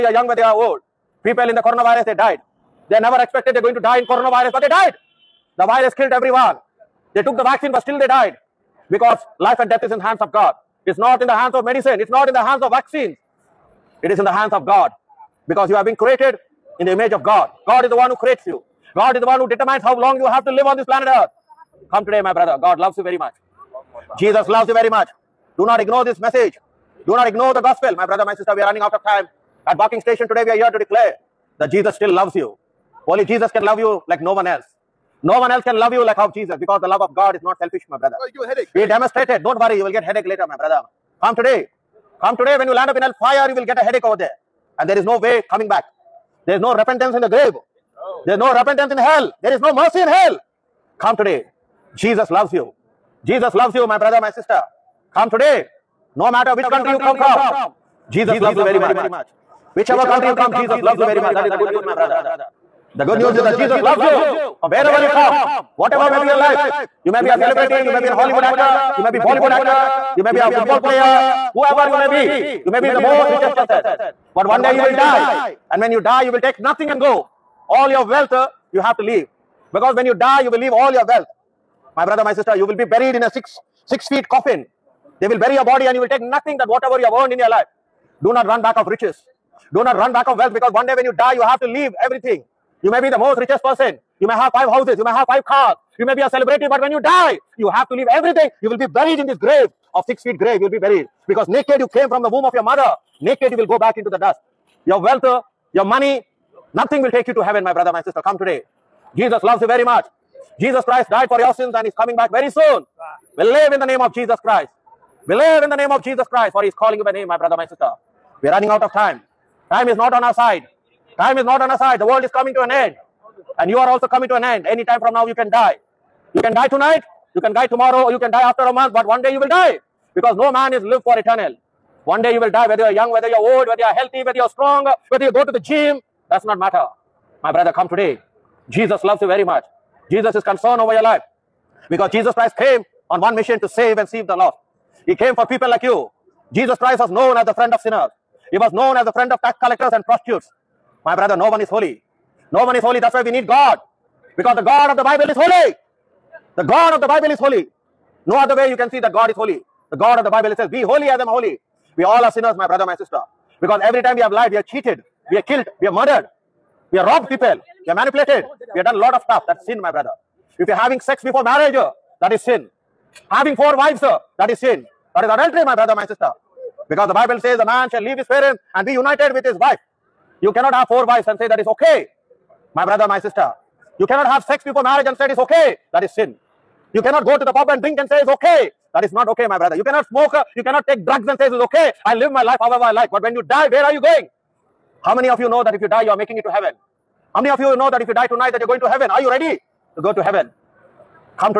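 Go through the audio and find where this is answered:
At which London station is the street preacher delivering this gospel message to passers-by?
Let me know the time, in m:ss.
0:29.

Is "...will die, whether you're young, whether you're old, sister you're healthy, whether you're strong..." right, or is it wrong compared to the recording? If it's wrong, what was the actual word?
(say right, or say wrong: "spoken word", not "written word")
wrong: "whether", not "sister".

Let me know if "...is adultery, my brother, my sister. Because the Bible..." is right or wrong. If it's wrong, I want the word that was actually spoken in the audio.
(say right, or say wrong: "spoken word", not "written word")
right.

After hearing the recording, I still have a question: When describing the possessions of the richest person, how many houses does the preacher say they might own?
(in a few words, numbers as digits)
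5.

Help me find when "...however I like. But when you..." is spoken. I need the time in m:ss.
3:12.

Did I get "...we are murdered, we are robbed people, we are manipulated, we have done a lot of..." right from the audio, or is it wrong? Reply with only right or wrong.
right.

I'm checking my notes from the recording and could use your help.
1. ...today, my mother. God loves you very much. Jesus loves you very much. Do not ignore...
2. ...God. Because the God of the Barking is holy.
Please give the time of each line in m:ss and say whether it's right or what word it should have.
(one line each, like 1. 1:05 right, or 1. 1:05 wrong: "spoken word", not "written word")
1. 0:22 wrong: "brother", not "mother"
2. 2:33 wrong: "Bible", not "Barking".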